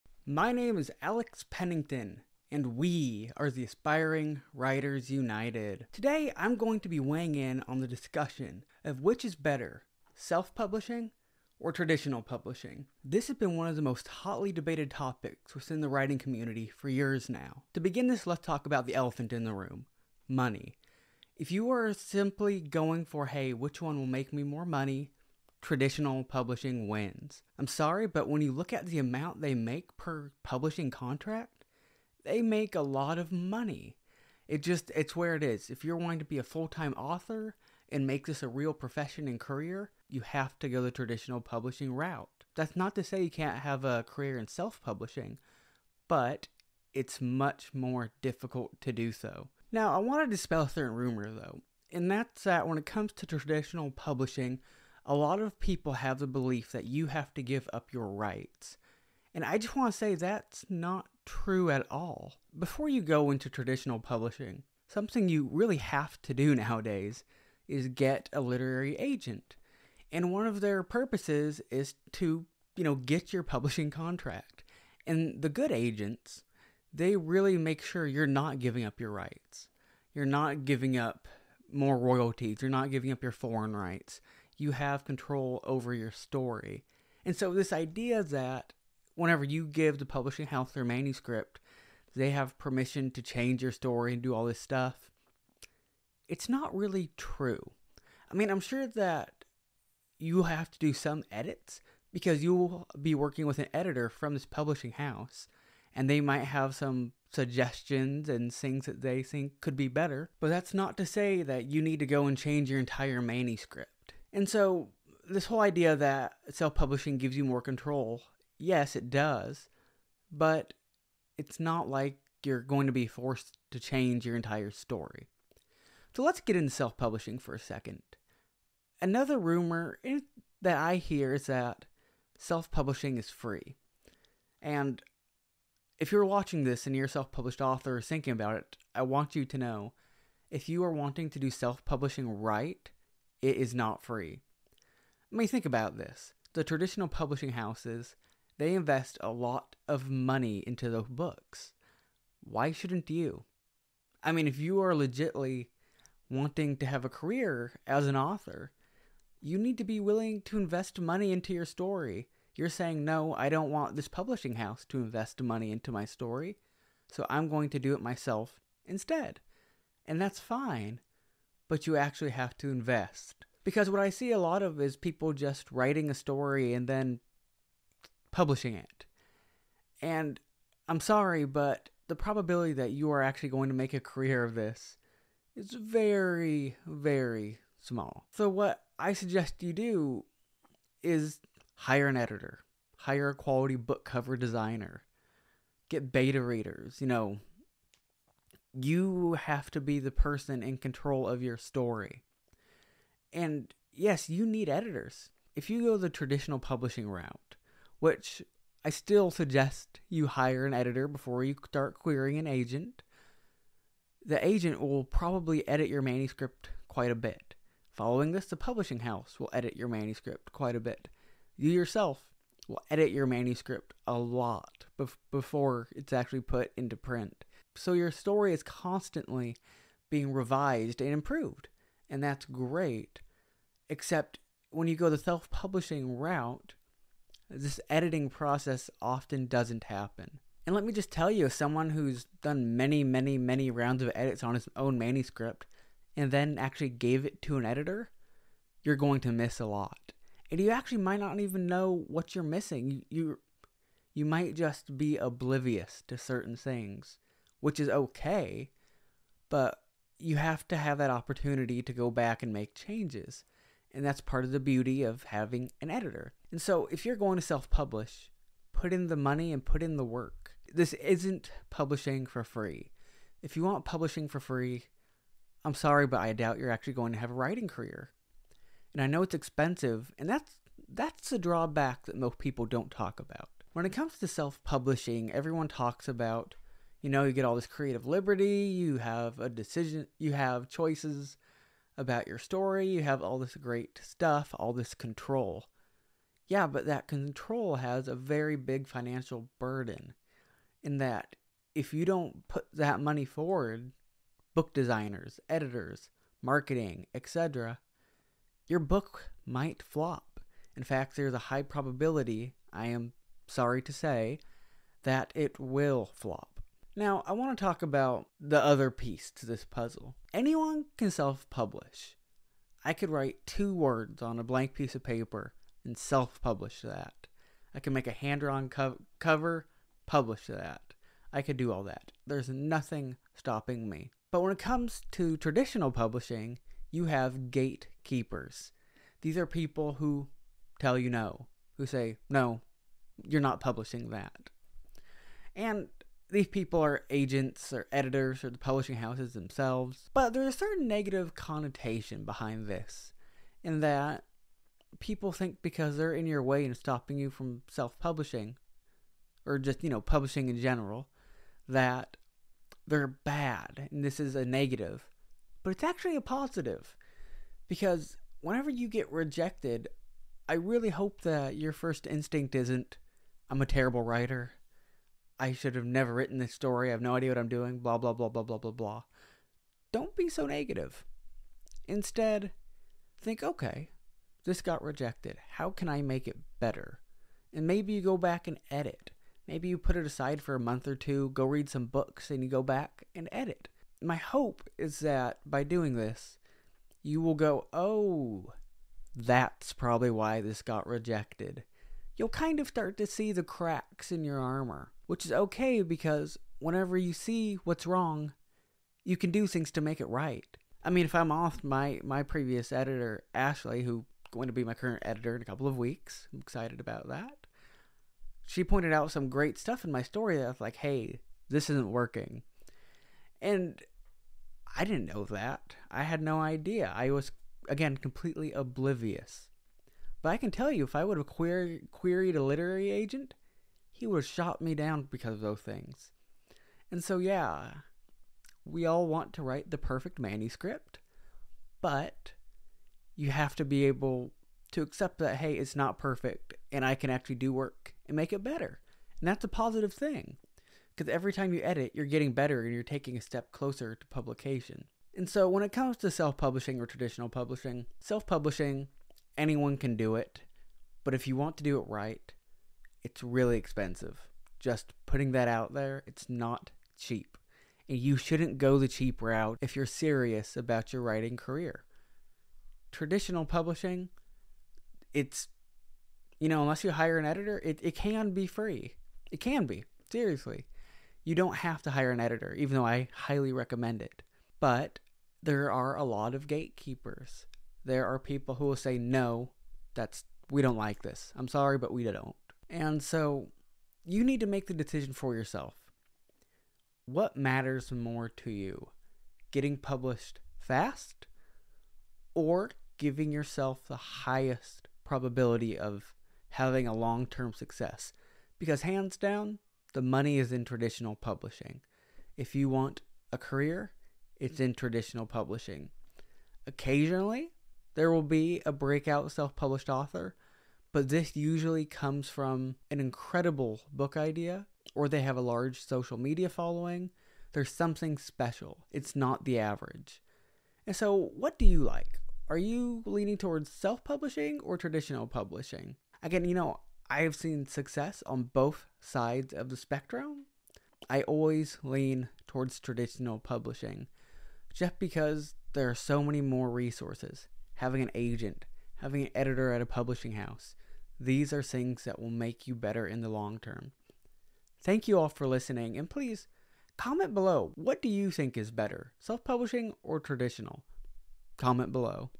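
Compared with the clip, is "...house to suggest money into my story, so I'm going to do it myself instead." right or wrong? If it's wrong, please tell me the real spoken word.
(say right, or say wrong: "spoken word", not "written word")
wrong: "invest", not "suggest".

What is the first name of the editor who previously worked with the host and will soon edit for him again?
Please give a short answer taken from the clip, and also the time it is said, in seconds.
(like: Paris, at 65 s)
Ashley, at 413 s.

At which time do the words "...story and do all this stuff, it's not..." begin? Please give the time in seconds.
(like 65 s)
93 s.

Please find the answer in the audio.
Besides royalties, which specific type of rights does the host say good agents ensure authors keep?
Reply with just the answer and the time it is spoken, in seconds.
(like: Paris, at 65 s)
foreign rights, at 83 s.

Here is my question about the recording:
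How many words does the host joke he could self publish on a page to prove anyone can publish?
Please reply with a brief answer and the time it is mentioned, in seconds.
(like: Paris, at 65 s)
2, at 323 s.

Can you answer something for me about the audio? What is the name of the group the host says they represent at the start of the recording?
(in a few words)
Aspiring Writers United.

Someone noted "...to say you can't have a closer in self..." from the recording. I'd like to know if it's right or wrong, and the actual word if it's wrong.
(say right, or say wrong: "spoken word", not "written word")
wrong: "career", not "closer".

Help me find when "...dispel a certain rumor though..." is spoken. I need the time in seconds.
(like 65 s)
50 s.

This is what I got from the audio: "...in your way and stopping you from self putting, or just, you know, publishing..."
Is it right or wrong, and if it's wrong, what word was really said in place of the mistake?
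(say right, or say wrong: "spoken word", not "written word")
wrong: "publishing", not "putting".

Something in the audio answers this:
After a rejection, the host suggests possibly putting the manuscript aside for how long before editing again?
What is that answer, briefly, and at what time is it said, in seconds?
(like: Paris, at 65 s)
a month or two, at 390 s.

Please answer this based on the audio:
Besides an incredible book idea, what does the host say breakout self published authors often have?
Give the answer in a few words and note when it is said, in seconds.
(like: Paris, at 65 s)
large social media following, at 525 s.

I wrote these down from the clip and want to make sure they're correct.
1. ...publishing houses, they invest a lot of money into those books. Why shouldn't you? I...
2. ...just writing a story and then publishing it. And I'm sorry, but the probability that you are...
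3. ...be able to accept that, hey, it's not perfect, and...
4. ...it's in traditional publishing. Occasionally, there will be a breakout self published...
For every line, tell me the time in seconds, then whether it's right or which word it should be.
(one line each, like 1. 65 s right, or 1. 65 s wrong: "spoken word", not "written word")
1. 147 s right
2. 175 s right
3. 443 s right
4. 514 s right.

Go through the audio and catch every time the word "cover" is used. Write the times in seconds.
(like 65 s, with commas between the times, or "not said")
194 s, 329 s.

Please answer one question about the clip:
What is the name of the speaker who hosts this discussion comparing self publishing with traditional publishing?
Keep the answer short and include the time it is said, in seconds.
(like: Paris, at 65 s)
Alex Pennington, at 1 s.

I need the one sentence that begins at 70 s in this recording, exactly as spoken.
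And one of their purposes is to, you know, get your publishing contract.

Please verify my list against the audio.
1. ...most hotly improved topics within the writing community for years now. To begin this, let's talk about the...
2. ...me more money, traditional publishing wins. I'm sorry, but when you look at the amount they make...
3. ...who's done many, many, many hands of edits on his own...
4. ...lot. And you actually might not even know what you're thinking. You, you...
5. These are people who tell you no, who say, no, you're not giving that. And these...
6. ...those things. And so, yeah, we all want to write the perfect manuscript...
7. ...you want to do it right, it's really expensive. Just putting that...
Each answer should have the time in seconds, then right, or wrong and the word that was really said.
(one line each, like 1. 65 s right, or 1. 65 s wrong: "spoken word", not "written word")
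1. 13 s wrong: "debated", not "improved"
2. 24 s right
3. 241 s wrong: "rounds", not "hands"
4. 249 s wrong: "missing", not "thinking"
5. 339 s wrong: "publishing", not "giving"
6. 435 s right
7. 461 s right.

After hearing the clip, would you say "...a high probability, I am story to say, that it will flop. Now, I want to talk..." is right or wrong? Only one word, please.
wrong.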